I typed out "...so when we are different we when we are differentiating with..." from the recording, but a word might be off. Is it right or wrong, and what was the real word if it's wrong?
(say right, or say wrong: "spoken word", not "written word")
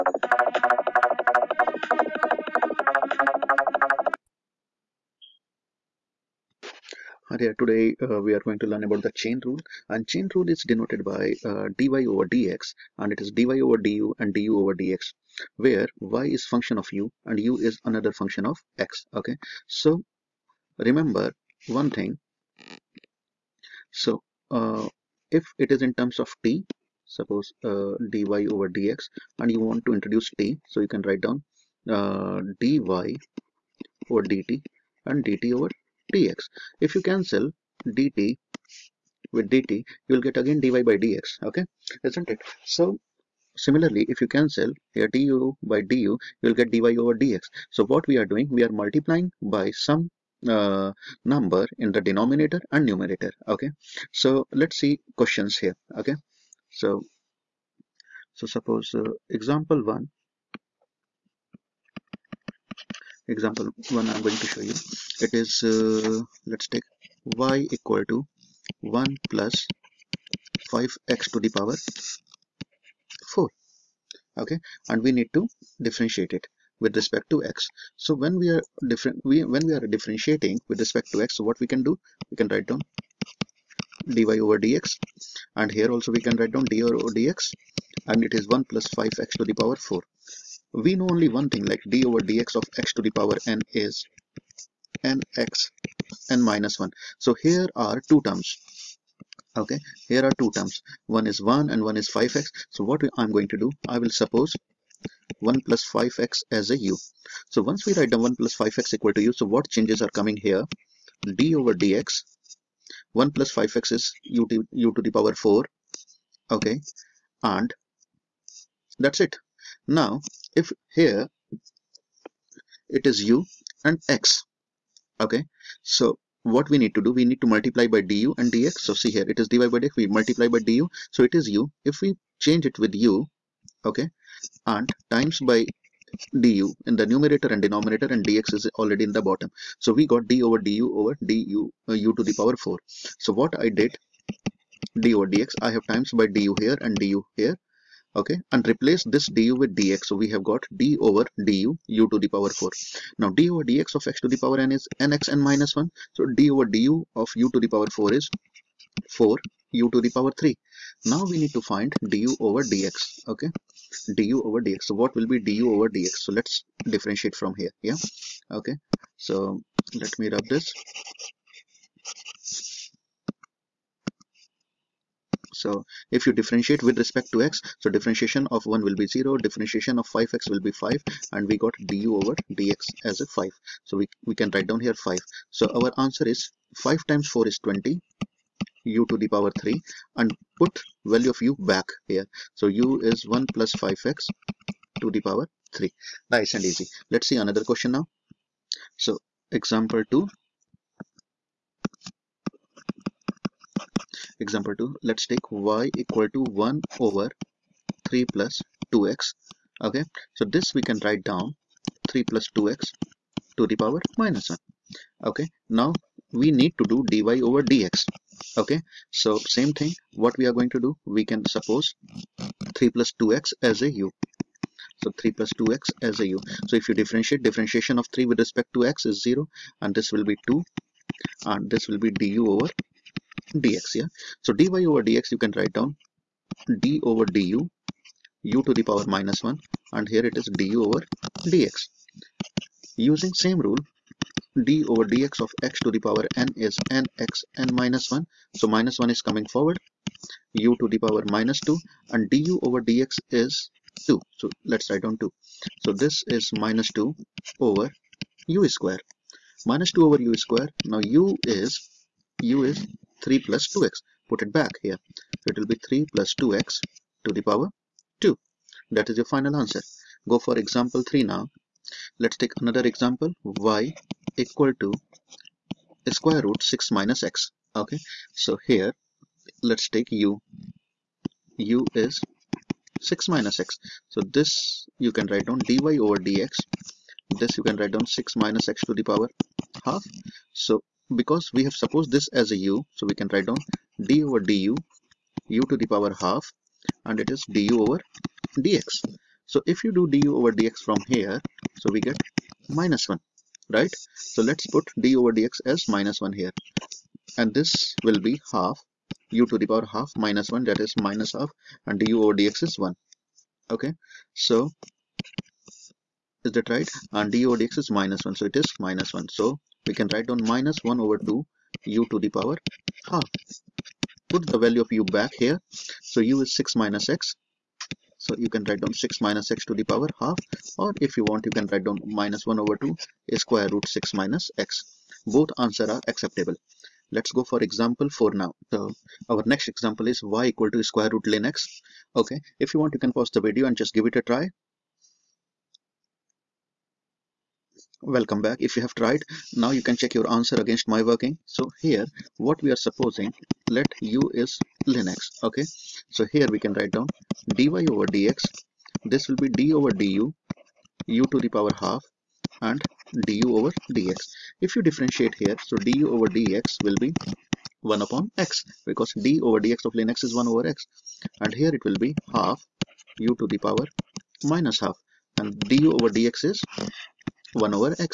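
right.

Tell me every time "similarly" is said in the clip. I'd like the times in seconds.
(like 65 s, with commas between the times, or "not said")
43 s.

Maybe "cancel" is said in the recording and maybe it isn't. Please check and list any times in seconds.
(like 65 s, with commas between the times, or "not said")
37 s, 44 s.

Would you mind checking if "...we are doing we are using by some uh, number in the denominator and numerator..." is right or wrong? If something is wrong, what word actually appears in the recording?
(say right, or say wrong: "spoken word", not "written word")
wrong: "multiplying", not "using".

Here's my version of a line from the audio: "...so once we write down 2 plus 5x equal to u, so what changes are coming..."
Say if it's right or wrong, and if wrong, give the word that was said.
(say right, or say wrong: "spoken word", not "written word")
wrong: "1", not "2".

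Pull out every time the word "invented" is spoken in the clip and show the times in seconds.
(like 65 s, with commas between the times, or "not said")
not said.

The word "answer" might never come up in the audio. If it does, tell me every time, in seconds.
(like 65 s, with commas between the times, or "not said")
186 s, 269 s, 335 s, 350 s.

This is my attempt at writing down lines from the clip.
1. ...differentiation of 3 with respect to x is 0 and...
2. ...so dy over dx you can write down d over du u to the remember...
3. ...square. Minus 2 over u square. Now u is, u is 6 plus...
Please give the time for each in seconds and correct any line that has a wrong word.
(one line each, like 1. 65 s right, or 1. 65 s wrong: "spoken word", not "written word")
1. 227 s right
2. 234 s wrong: "power", not "remember"
3. 258 s wrong: "3", not "6".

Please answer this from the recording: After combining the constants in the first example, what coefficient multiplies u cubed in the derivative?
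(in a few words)
20.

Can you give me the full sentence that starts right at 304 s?
So let's put d over dx as minus 1 here.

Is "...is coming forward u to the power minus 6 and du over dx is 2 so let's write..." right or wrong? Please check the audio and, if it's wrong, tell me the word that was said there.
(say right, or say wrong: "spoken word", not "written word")
wrong: "2", not "6".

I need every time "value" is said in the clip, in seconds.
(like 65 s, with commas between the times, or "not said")
191 s, 324 s.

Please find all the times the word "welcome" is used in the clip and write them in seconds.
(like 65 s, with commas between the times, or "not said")
348 s.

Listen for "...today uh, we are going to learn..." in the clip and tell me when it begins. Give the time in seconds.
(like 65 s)
7 s.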